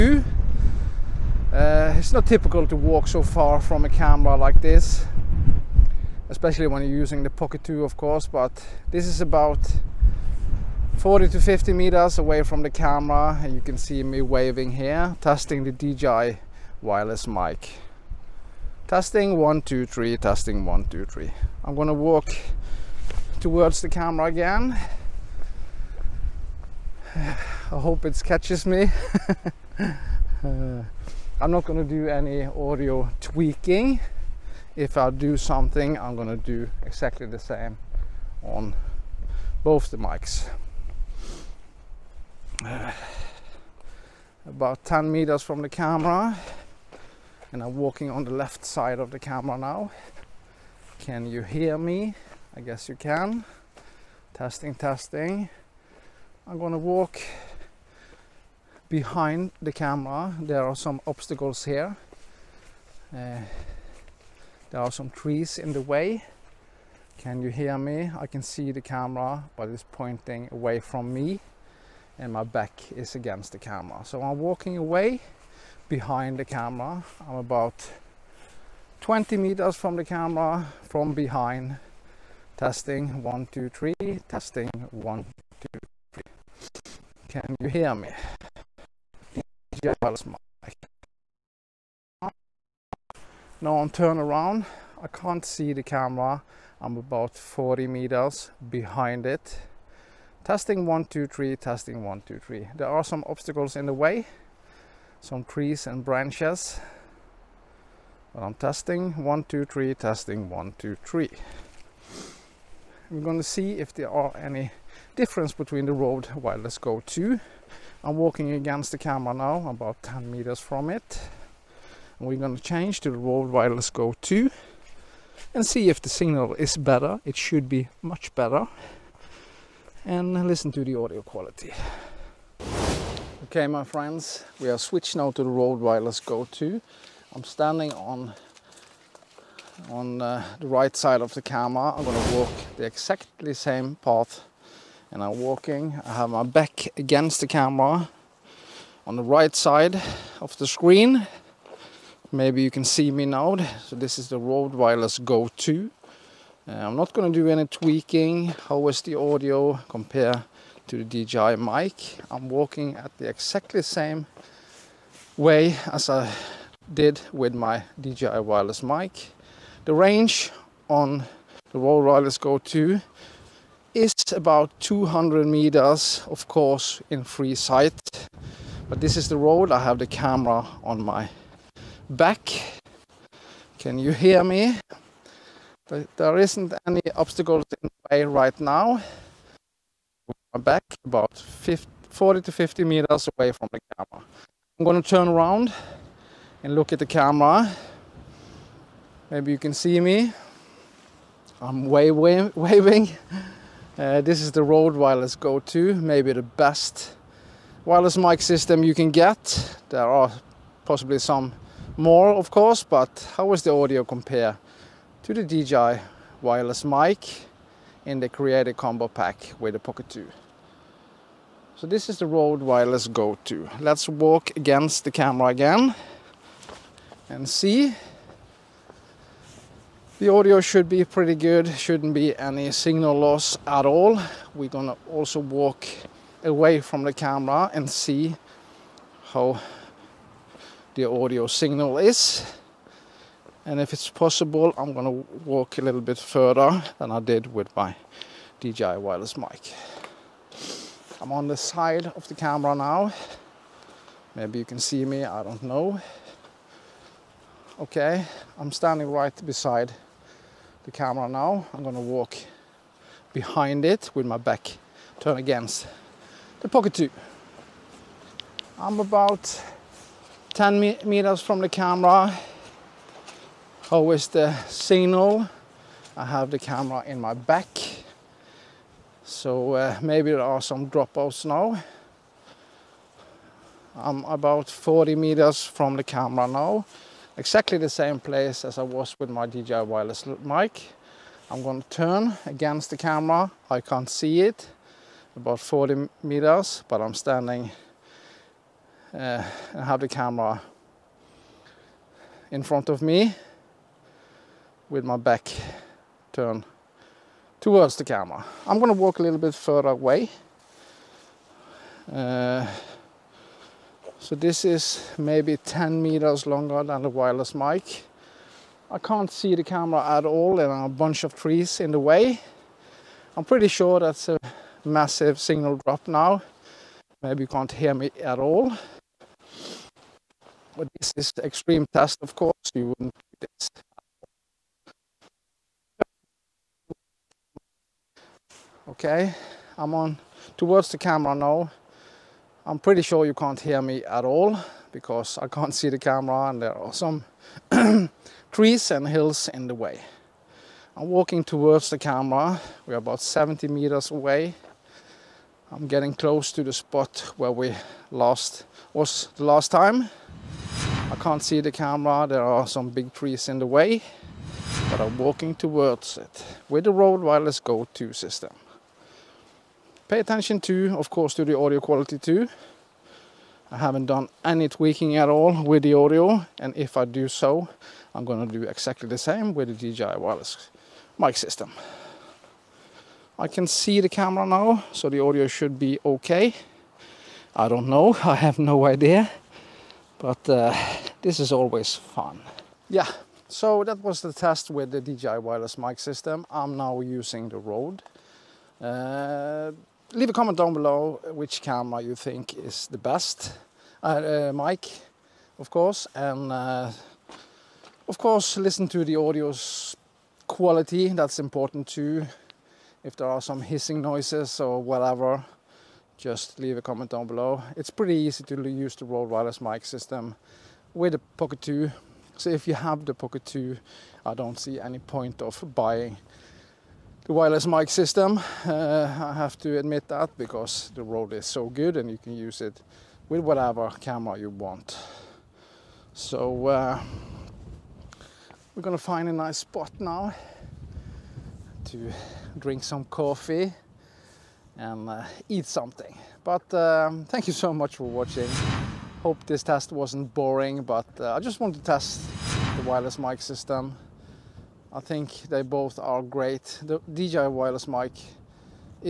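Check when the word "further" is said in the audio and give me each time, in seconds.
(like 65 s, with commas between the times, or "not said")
246 s, 309 s.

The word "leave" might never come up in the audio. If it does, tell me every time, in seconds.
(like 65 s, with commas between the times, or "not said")
400 s, 416 s.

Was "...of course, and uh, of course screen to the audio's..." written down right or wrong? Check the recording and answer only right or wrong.
wrong.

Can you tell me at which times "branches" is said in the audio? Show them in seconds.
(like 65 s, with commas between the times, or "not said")
106 s.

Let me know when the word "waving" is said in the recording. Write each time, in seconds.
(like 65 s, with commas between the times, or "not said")
14 s, 202 s.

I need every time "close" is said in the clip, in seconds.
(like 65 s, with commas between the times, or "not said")
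356 s.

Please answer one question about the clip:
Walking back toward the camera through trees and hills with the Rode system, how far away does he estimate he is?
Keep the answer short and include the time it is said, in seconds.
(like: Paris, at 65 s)
70 meters, at 353 s.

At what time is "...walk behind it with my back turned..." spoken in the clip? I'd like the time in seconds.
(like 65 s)
262 s.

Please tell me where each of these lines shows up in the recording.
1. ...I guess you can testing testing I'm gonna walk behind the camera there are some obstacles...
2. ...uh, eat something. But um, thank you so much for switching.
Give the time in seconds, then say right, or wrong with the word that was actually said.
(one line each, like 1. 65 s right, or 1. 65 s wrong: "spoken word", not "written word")
1. 52 s right
2. 445 s wrong: "watching", not "switching".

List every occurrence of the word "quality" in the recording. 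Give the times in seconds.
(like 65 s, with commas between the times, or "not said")
131 s, 371 s, 410 s.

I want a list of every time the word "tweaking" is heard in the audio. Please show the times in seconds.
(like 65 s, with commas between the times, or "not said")
33 s, 157 s, 374 s.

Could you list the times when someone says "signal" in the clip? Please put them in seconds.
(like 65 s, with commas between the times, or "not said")
126 s, 232 s, 241 s, 274 s, 325 s.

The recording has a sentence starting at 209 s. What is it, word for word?
There are possibly some more, of course, but how is the audio compare?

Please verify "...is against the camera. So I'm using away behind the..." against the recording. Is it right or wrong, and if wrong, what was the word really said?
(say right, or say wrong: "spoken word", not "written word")
wrong: "walking", not "using".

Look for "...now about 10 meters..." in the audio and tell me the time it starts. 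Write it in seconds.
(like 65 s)
119 s.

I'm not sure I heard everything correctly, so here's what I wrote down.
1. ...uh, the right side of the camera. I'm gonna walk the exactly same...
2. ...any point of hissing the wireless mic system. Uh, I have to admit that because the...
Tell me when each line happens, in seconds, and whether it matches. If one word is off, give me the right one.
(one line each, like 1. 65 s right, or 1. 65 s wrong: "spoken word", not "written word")
1. 140 s right
2. 424 s wrong: "buying", not "hissing".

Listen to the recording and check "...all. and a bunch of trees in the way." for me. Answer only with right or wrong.
right.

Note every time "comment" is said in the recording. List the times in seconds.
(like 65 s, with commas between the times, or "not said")
400 s, 416 s.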